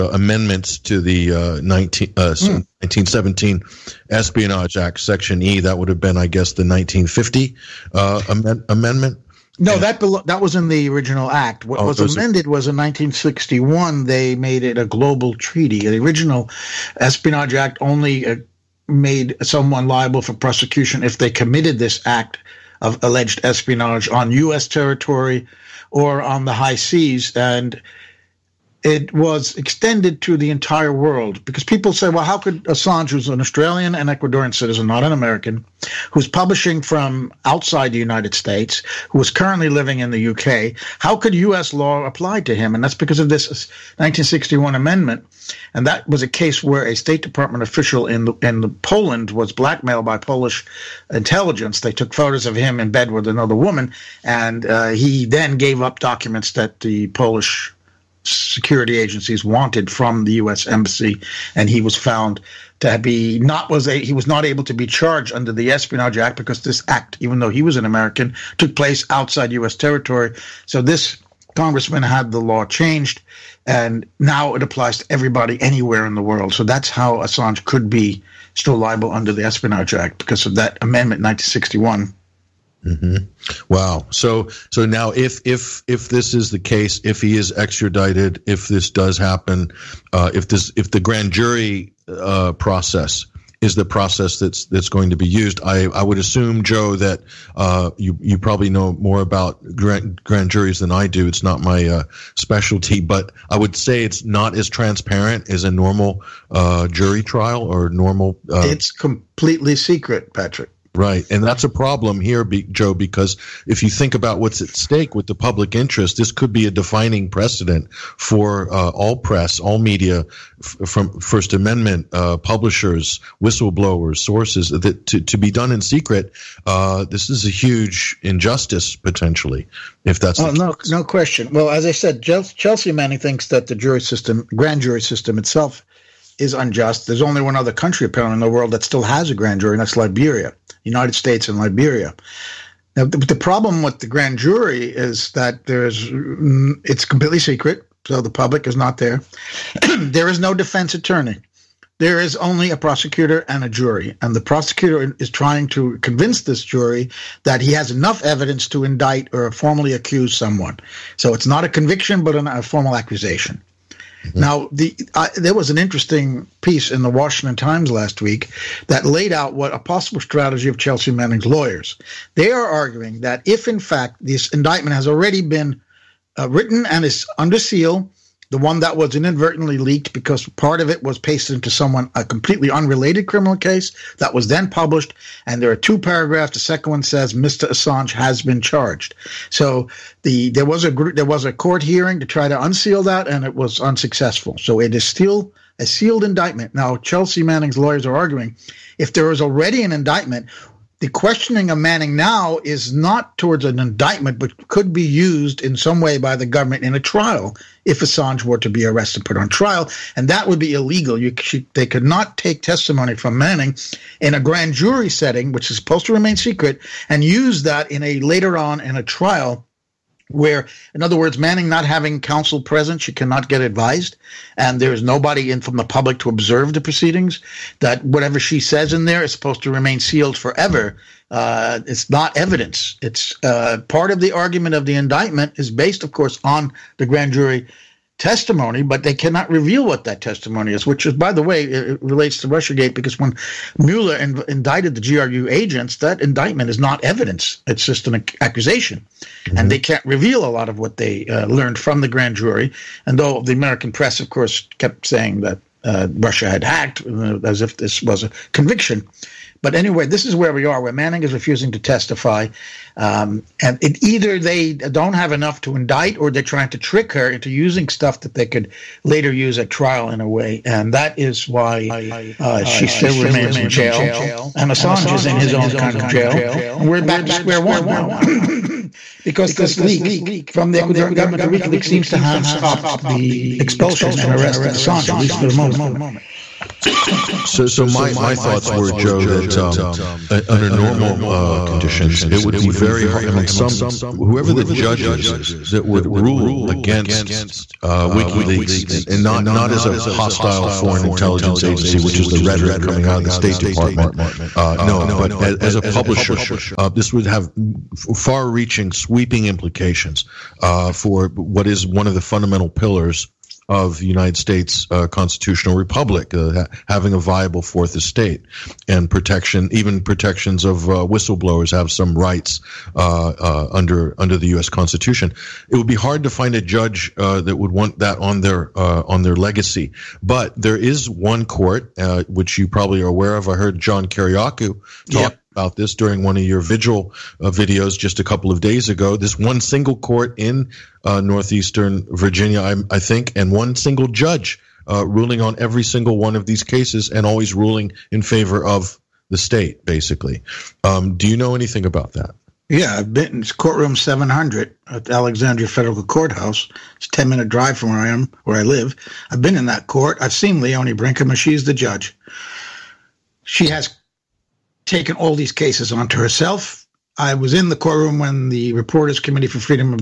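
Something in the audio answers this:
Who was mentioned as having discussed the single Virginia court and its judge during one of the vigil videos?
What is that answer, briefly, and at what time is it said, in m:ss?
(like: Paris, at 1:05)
John Kiriakou, at 5:33.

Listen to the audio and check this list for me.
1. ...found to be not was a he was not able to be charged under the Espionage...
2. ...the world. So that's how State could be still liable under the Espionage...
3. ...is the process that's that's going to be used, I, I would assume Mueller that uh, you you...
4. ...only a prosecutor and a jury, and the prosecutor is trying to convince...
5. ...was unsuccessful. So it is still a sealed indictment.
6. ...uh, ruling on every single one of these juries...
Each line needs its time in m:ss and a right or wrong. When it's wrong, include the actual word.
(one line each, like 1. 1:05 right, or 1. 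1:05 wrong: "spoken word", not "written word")
1. 1:01 right
2. 1:16 wrong: "Assange", not "State"
3. 1:33 wrong: "Joe", not "Mueller"
4. 2:32 right
5. 3:13 right
6. 5:44 wrong: "cases", not "juries".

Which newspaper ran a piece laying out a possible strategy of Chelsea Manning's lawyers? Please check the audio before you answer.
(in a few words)
Washington Times.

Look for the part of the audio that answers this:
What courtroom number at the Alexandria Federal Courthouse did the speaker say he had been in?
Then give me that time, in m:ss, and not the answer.
5:53.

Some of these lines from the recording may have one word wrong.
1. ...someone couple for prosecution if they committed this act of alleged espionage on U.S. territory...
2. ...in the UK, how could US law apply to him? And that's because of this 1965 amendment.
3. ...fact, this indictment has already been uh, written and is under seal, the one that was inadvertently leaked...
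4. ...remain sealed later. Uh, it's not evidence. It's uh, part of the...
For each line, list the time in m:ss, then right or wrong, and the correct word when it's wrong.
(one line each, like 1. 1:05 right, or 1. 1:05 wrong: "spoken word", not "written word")
1. 0:19 wrong: "liable", not "couple"
2. 0:39 wrong: "1961", not "1965"
3. 2:53 right
4. 3:49 wrong: "forever", not "later".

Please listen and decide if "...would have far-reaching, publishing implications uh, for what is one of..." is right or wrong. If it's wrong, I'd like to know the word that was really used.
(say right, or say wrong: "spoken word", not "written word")
wrong: "sweeping", not "publishing".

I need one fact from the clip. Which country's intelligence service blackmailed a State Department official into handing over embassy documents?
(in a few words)
Poland.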